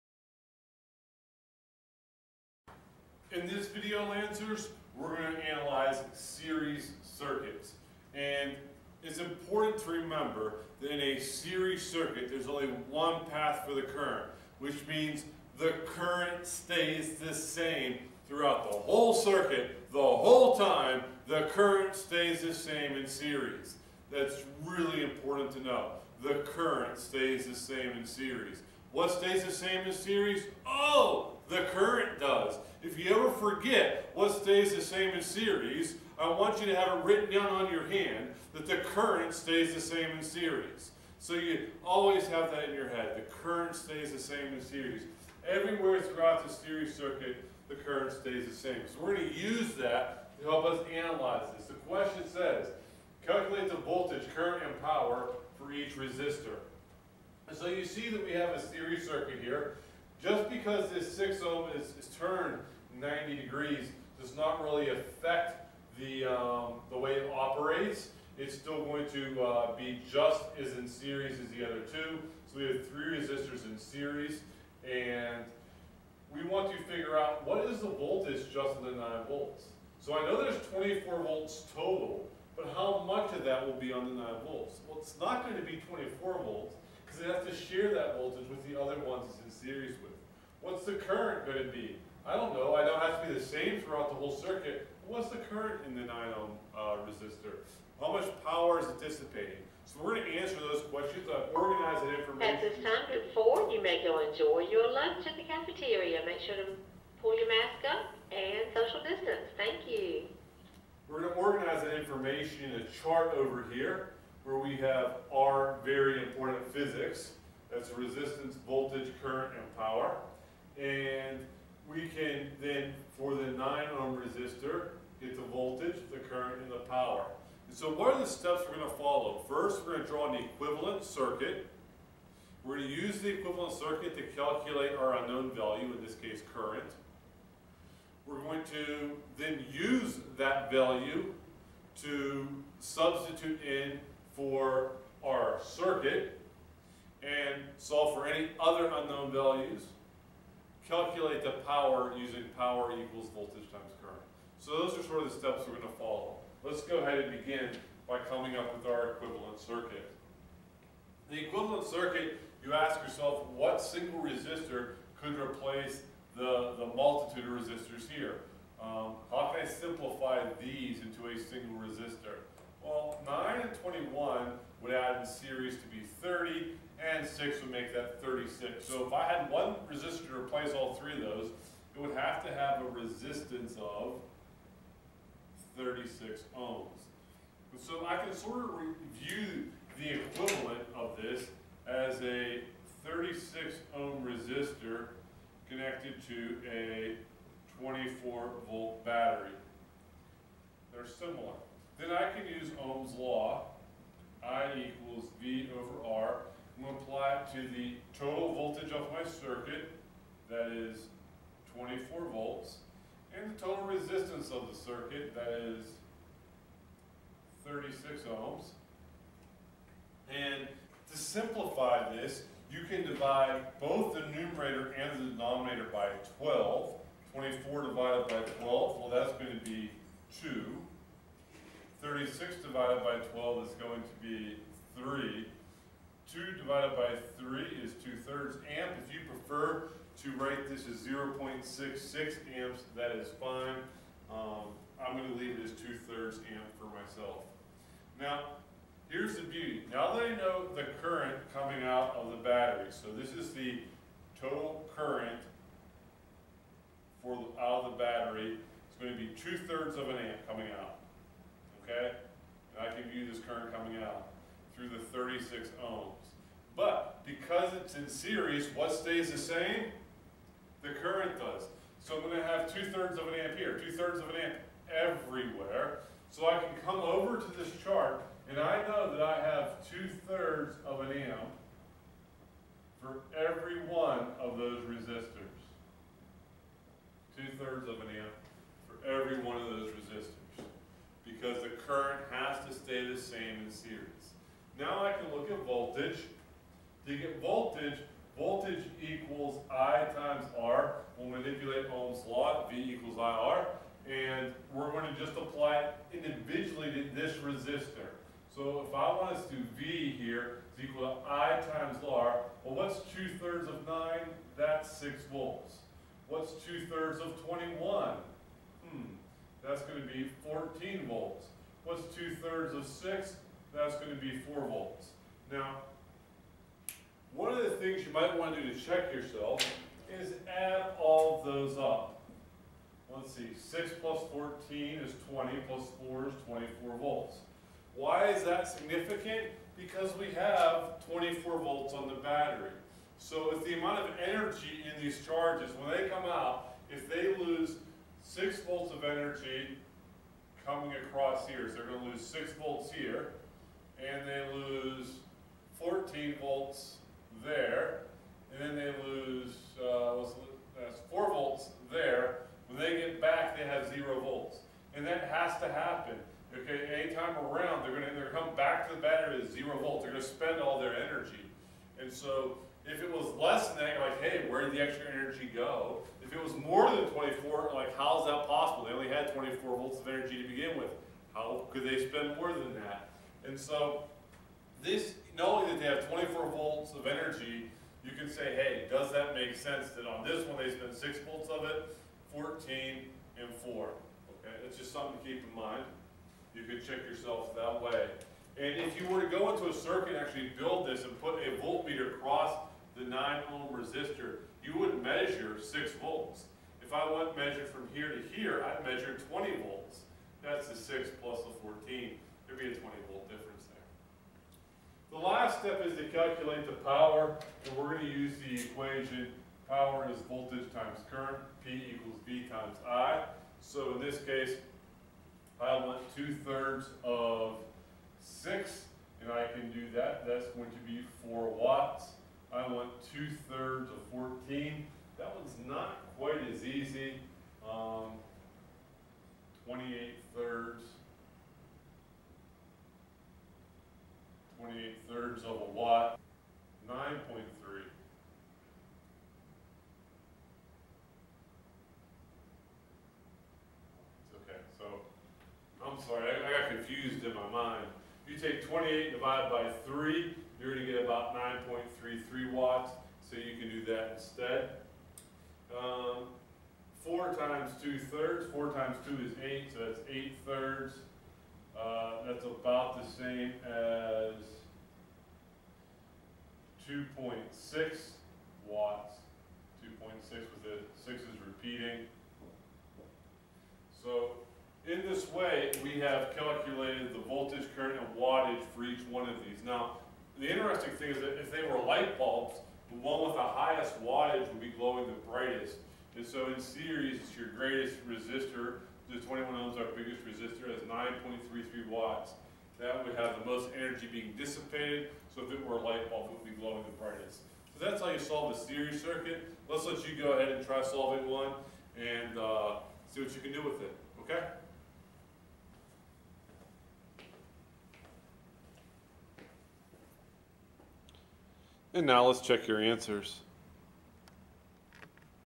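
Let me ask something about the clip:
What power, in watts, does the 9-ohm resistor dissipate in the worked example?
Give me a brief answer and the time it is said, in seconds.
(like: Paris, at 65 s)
4 watts, at 431 s.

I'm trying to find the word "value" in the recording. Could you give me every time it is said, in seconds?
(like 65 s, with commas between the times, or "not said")
135 s, 140 s, 149 s.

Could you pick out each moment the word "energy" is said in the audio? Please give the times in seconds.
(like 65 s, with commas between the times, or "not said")
344 s, 349 s, 370 s, 375 s, 380 s, 387 s, 503 s.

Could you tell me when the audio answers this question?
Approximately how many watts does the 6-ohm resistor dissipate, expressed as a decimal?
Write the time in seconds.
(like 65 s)
476 s.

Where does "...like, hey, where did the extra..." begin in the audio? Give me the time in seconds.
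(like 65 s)
374 s.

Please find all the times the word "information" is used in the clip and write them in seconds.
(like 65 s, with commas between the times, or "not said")
102 s, 111 s.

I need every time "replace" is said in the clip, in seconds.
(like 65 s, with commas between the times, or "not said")
165 s, 180 s.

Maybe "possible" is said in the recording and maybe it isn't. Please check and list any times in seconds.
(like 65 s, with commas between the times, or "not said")
378 s.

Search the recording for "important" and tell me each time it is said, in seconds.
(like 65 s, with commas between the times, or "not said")
9 s, 25 s, 116 s.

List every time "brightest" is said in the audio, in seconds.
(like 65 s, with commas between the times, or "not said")
495 s, 507 s.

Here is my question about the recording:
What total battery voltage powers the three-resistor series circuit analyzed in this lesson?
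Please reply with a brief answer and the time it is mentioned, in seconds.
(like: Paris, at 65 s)
24 volts, at 80 s.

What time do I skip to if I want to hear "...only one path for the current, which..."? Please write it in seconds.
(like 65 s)
12 s.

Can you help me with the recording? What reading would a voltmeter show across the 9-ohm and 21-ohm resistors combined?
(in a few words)
20 volts.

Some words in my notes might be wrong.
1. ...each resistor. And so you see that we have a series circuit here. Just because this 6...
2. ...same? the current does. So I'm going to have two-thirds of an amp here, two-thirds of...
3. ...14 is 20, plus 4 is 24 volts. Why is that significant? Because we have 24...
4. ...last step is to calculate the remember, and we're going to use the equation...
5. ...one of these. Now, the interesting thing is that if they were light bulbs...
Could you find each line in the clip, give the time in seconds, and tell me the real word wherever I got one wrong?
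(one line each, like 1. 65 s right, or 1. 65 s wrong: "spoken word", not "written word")
1. 55 s right
2. 269 s right
3. 334 s right
4. 415 s wrong: "power", not "remember"
5. 489 s right.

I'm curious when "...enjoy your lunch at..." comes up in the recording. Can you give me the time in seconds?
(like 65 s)
104 s.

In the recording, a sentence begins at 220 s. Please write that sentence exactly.
And to simplify this, you can divide both the numerator and the denominator by 12.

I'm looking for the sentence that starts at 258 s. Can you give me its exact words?
It's going to be 2 thirds of an amp coming out.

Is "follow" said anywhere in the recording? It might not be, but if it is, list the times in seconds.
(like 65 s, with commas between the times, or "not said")
128 s, 155 s.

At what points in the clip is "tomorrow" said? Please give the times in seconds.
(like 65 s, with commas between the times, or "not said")
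not said.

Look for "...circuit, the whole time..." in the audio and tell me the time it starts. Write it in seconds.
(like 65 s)
19 s.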